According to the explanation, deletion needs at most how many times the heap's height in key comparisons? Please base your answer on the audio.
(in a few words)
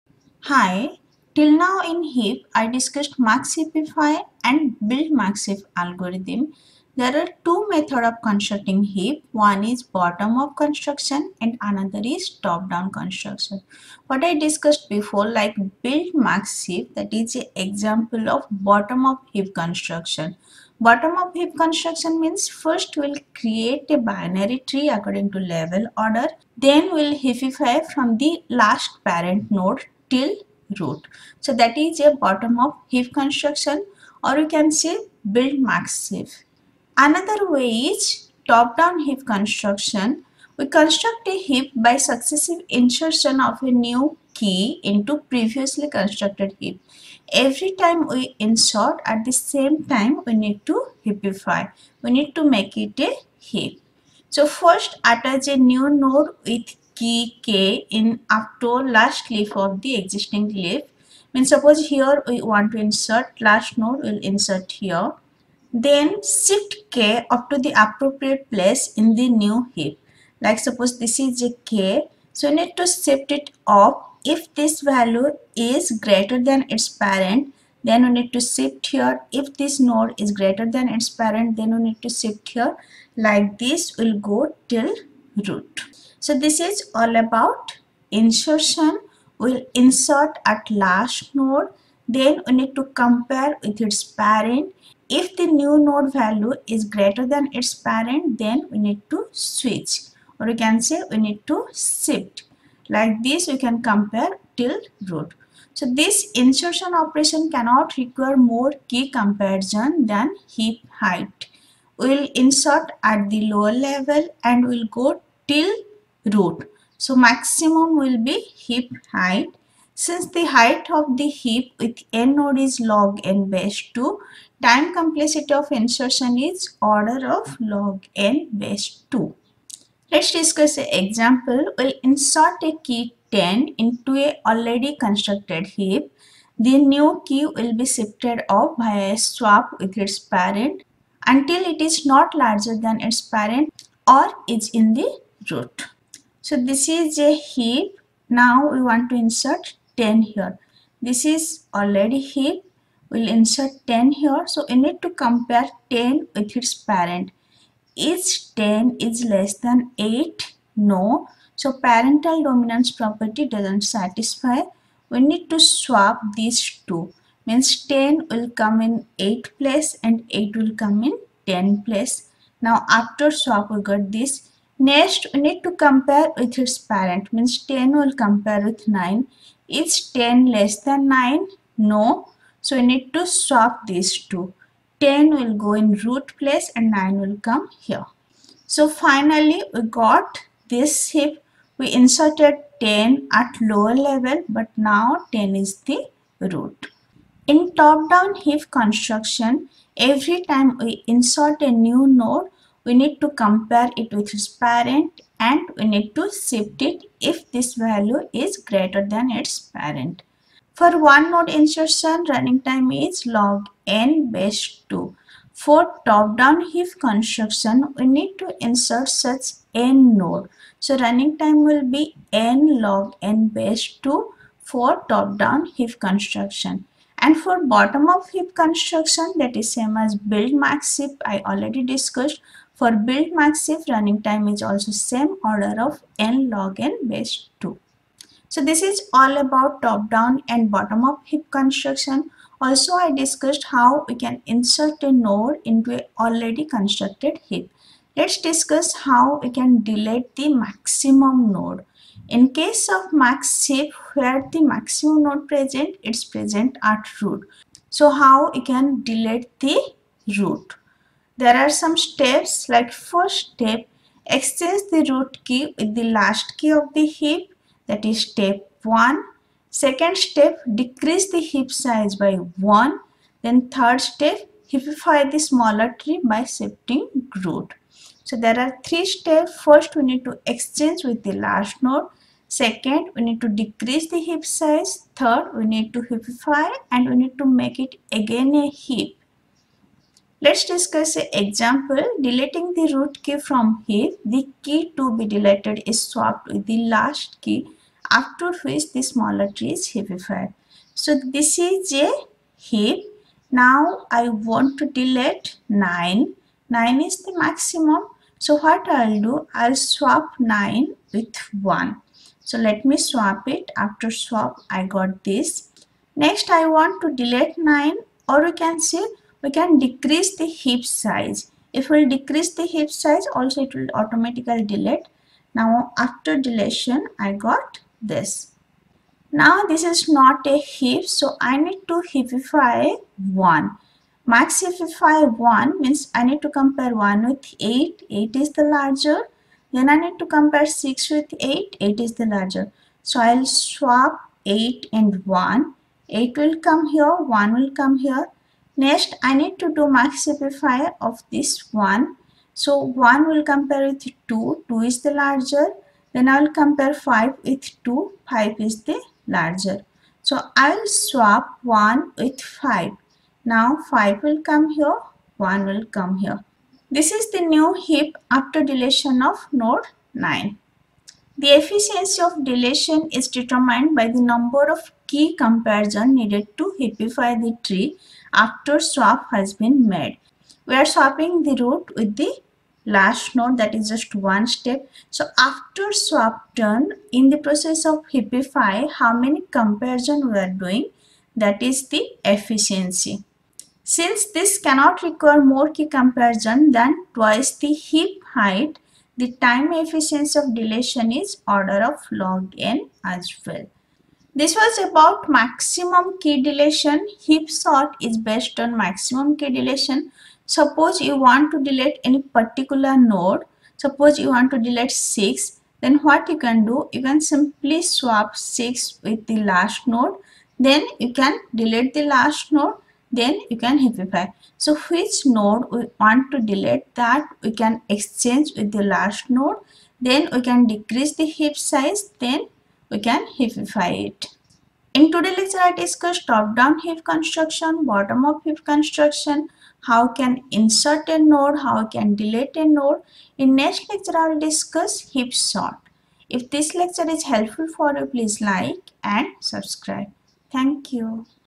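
twice.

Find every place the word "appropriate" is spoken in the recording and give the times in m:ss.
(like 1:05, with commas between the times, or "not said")
1:07.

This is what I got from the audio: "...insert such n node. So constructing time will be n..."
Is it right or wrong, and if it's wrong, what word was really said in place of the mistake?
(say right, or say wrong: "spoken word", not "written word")
wrong: "running", not "constructing".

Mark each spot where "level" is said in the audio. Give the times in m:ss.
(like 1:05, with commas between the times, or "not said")
0:25, 1:53, 3:13.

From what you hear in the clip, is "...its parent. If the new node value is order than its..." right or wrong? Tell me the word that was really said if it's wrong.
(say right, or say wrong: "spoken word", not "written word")
wrong: "greater", not "order".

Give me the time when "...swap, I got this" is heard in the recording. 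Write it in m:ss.
5:14.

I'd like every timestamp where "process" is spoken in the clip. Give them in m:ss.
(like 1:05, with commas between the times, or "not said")
6:27.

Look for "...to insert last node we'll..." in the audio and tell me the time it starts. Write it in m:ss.
1:02.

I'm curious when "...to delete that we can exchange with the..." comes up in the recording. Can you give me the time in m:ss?
7:06.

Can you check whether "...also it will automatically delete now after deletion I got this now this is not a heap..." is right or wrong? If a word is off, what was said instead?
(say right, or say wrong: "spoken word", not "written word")
right.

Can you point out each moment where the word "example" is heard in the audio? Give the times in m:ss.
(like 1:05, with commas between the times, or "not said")
0:17, 2:10, 4:51.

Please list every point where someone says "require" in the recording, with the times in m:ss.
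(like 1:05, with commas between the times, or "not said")
1:47, 6:35.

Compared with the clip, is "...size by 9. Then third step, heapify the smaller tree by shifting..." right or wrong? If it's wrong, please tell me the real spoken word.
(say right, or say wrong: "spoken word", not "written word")
wrong: "1", not "9".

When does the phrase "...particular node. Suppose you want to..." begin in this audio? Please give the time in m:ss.
6:52.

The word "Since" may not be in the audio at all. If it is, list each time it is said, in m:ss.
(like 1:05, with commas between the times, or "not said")
1:59, 6:33.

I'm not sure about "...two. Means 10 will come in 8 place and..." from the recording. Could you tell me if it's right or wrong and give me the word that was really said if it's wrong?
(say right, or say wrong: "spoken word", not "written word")
right.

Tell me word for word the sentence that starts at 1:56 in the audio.
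So maximum will be heap height.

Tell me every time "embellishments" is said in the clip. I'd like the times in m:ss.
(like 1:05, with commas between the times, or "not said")
not said.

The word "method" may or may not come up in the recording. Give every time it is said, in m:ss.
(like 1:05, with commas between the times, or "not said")
0:07.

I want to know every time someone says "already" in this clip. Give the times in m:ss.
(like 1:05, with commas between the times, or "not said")
2:14, 2:31, 3:51, 4:06.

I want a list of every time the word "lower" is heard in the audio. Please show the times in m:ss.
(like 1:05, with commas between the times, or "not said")
1:53, 3:13.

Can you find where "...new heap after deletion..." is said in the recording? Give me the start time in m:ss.
6:07.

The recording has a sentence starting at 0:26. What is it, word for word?
Then we'll heapify from the last parent node till root.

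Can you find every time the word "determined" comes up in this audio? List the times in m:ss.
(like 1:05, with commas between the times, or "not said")
6:13.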